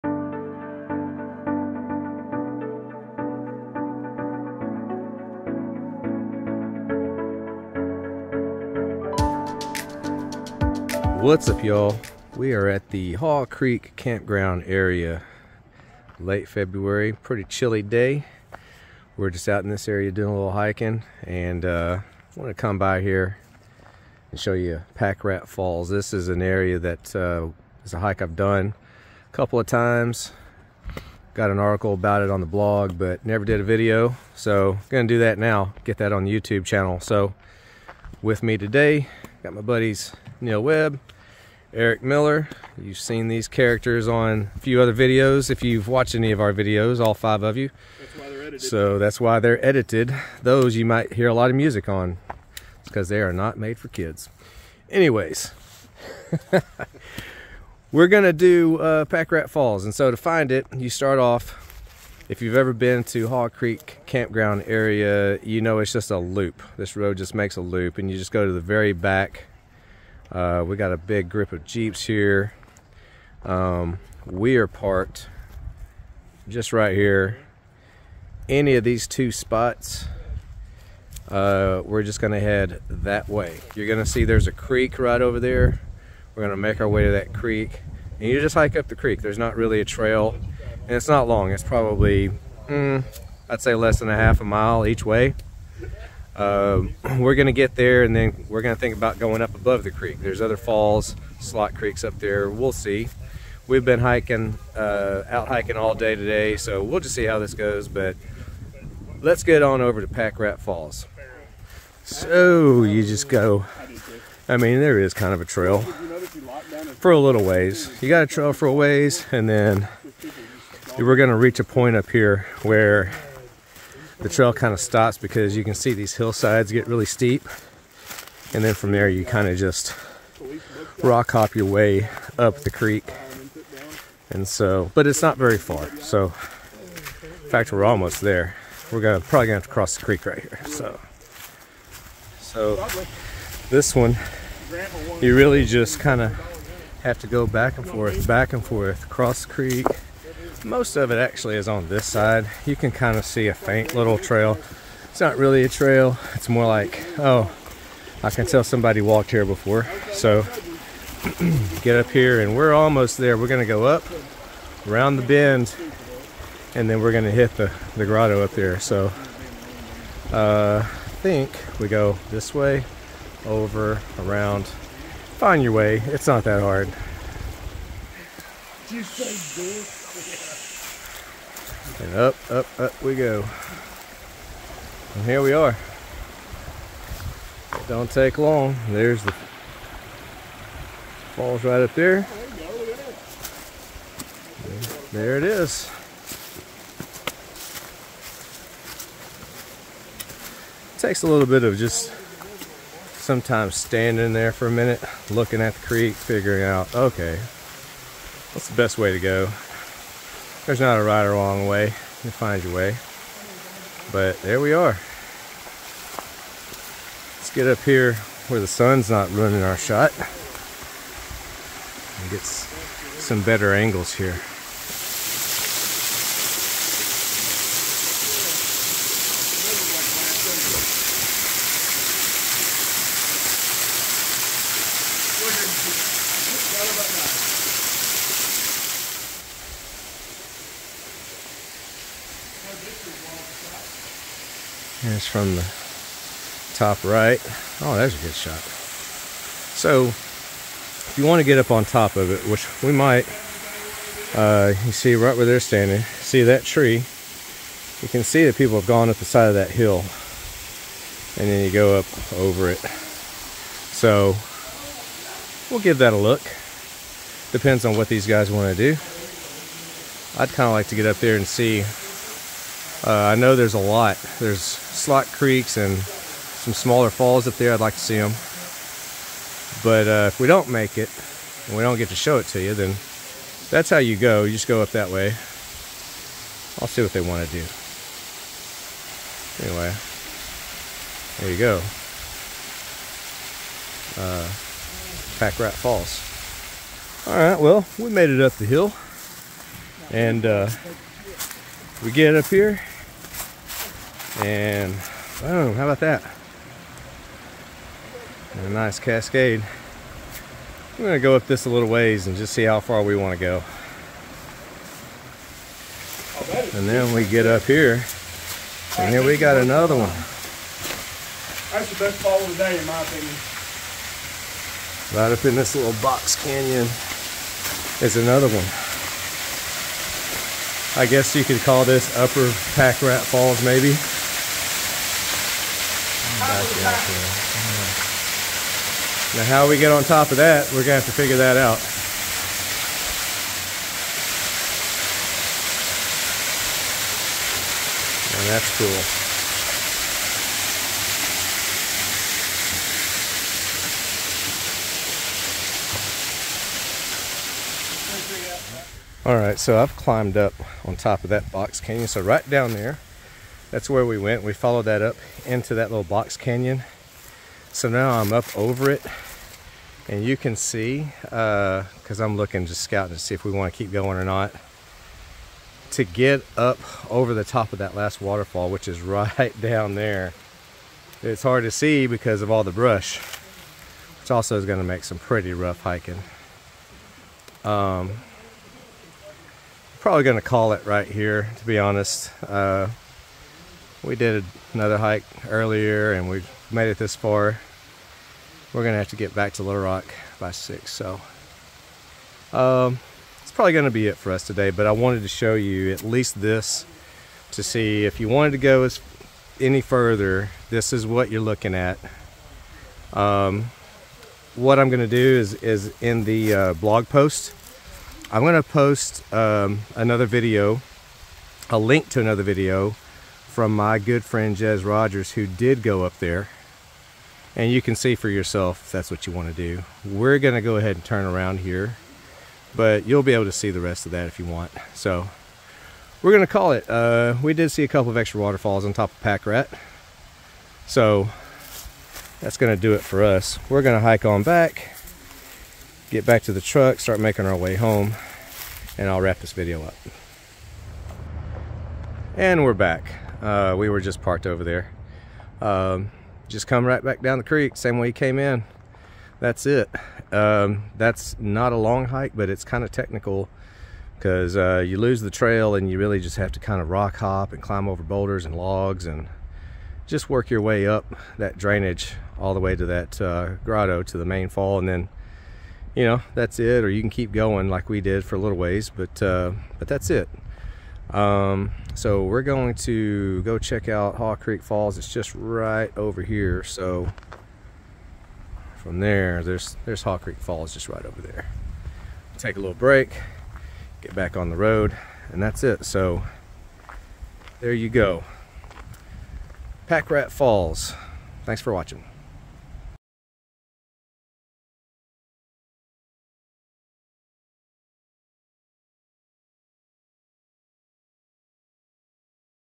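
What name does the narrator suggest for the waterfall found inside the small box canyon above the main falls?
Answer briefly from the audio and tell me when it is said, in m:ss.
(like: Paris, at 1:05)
Upper Pack Rat Falls, at 5:32.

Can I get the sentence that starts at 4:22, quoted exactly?
So, we'll give that a look.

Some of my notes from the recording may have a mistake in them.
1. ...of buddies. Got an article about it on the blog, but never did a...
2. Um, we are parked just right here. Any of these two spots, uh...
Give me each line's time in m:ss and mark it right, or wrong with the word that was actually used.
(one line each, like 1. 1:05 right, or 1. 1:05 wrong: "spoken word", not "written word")
1. 0:29 wrong: "times", not "buddies"
2. 1:13 right.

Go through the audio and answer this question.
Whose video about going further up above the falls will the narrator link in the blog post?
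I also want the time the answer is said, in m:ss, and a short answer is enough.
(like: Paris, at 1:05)
Jez Rogers, at 7:04.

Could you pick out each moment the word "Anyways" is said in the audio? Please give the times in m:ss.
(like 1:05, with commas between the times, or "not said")
0:54, 4:49.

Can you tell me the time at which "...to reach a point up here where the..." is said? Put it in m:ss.
2:01.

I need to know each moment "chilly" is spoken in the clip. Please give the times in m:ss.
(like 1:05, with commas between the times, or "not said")
0:17.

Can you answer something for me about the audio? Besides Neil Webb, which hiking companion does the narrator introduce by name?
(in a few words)
Eric Miller.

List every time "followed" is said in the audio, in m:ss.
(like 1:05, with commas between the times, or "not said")
6:04.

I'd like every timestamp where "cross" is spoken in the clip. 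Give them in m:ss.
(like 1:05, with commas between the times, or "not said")
2:19, 2:29.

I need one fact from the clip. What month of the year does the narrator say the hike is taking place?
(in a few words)
February.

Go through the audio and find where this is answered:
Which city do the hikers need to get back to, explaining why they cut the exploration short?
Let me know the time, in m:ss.
6:39.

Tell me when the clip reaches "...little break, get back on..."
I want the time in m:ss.
8:12.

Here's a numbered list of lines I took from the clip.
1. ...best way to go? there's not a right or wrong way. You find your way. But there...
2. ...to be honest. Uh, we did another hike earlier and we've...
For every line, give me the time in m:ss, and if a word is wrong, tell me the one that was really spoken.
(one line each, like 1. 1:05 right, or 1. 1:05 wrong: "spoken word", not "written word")
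1. 3:28 right
2. 6:31 right.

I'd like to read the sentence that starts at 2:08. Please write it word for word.
And then from there you kind of just rock hop your way up the creek.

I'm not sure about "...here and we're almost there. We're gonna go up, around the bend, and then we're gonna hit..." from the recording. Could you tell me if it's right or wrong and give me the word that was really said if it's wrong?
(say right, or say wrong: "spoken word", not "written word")
right.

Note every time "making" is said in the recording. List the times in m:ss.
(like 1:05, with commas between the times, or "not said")
7:27.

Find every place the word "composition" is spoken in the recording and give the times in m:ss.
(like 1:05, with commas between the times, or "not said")
not said.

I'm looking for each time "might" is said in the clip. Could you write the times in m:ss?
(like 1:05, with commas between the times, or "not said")
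0:50, 4:12.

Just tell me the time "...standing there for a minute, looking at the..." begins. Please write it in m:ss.
3:23.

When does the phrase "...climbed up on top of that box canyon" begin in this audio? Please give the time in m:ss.
5:59.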